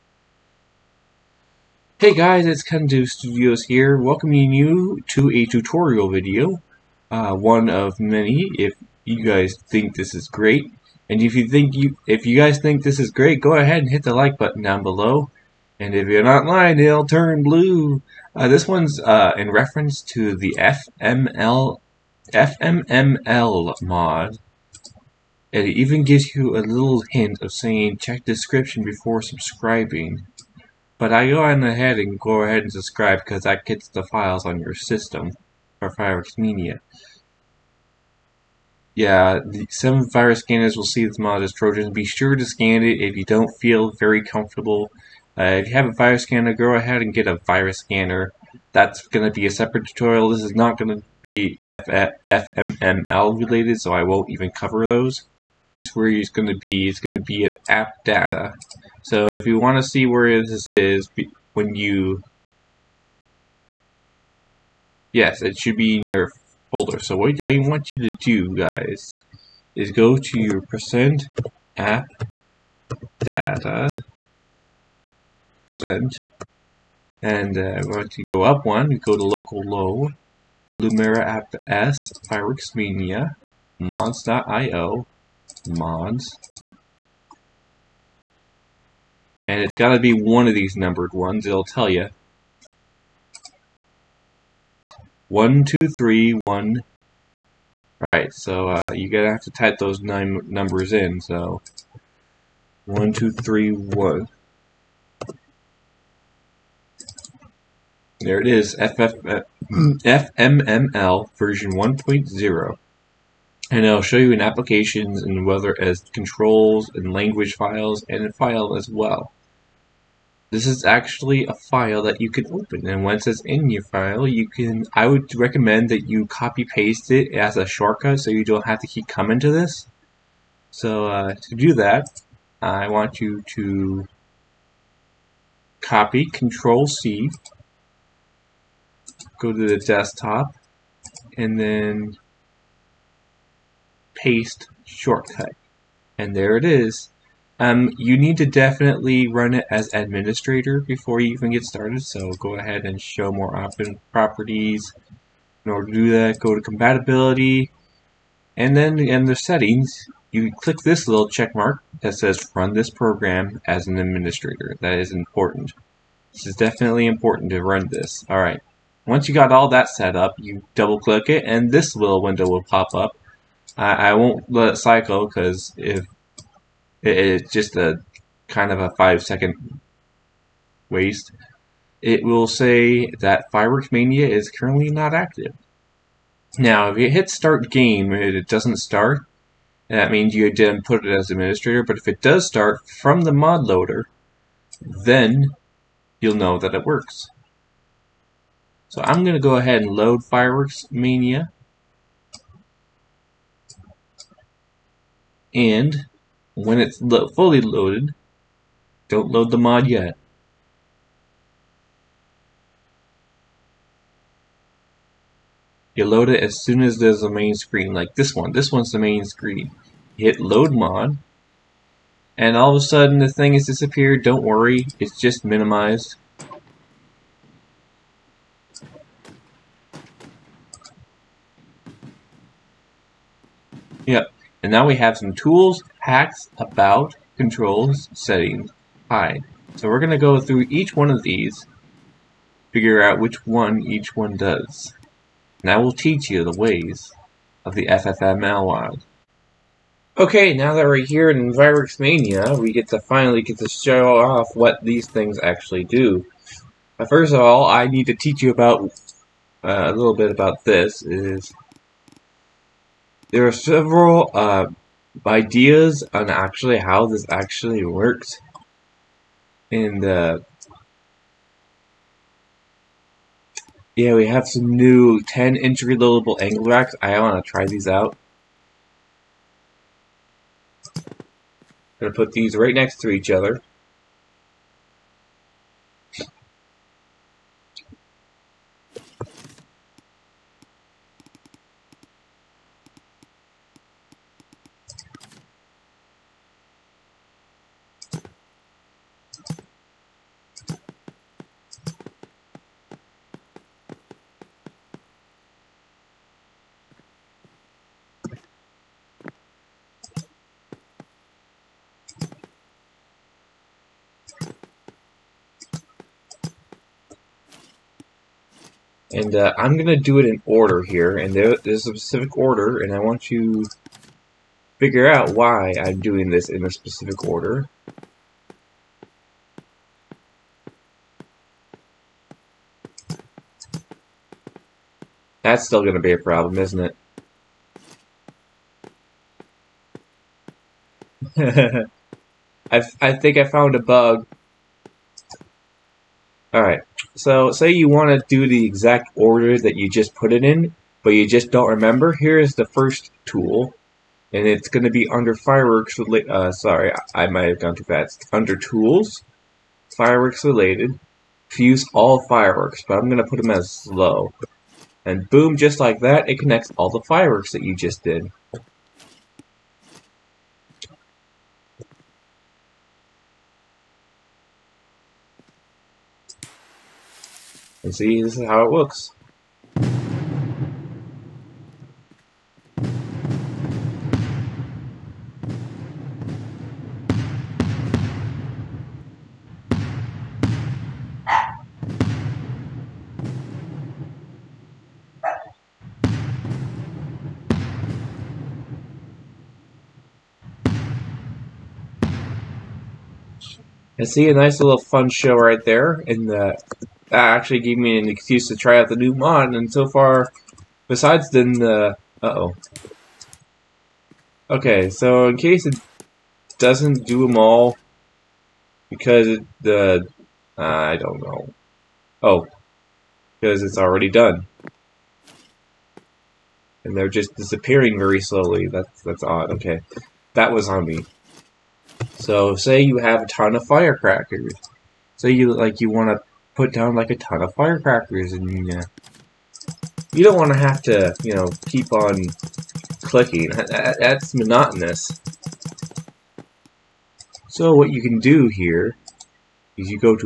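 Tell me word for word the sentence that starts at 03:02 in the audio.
It will say that Fireworks Mania is currently not active.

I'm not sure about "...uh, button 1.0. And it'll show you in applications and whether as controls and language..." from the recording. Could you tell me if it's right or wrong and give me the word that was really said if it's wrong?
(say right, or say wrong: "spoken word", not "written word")
wrong: "version", not "button".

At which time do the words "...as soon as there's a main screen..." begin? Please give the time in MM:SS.
03:36.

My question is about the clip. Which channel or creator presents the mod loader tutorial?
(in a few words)
KenDo Studios.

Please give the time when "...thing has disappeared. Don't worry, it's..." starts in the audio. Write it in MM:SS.
03:43.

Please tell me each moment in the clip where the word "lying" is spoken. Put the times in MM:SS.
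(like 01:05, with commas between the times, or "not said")
00:16.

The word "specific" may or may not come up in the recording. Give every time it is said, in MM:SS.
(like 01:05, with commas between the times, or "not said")
05:21, 05:26.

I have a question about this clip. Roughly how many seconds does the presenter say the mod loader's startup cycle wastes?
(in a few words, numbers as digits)
5.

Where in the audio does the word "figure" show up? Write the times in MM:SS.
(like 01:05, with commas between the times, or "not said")
04:02, 05:24.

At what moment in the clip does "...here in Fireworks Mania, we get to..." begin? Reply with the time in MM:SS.
04:11.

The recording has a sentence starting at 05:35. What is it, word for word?
That's still going to be a problem, isn't it?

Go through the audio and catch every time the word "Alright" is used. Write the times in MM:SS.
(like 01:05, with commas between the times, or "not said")
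01:38, 02:48, 05:46.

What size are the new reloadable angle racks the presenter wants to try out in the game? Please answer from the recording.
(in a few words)
10 inch.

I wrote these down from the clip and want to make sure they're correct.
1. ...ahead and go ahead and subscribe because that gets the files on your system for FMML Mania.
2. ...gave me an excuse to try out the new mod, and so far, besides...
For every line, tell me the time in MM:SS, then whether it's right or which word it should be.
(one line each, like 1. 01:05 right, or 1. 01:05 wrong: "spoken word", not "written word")
1. 00:31 wrong: "Fireworks", not "FMML"
2. 06:47 right.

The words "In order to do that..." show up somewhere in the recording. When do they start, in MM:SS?
02:35.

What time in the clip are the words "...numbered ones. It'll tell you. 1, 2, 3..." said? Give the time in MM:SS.
01:30.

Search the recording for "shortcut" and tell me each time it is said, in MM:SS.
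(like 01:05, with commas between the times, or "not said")
02:07, 02:24.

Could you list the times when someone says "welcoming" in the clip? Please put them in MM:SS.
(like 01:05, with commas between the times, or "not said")
00:03.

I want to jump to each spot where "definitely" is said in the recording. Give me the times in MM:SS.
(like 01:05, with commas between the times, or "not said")
02:28, 02:46.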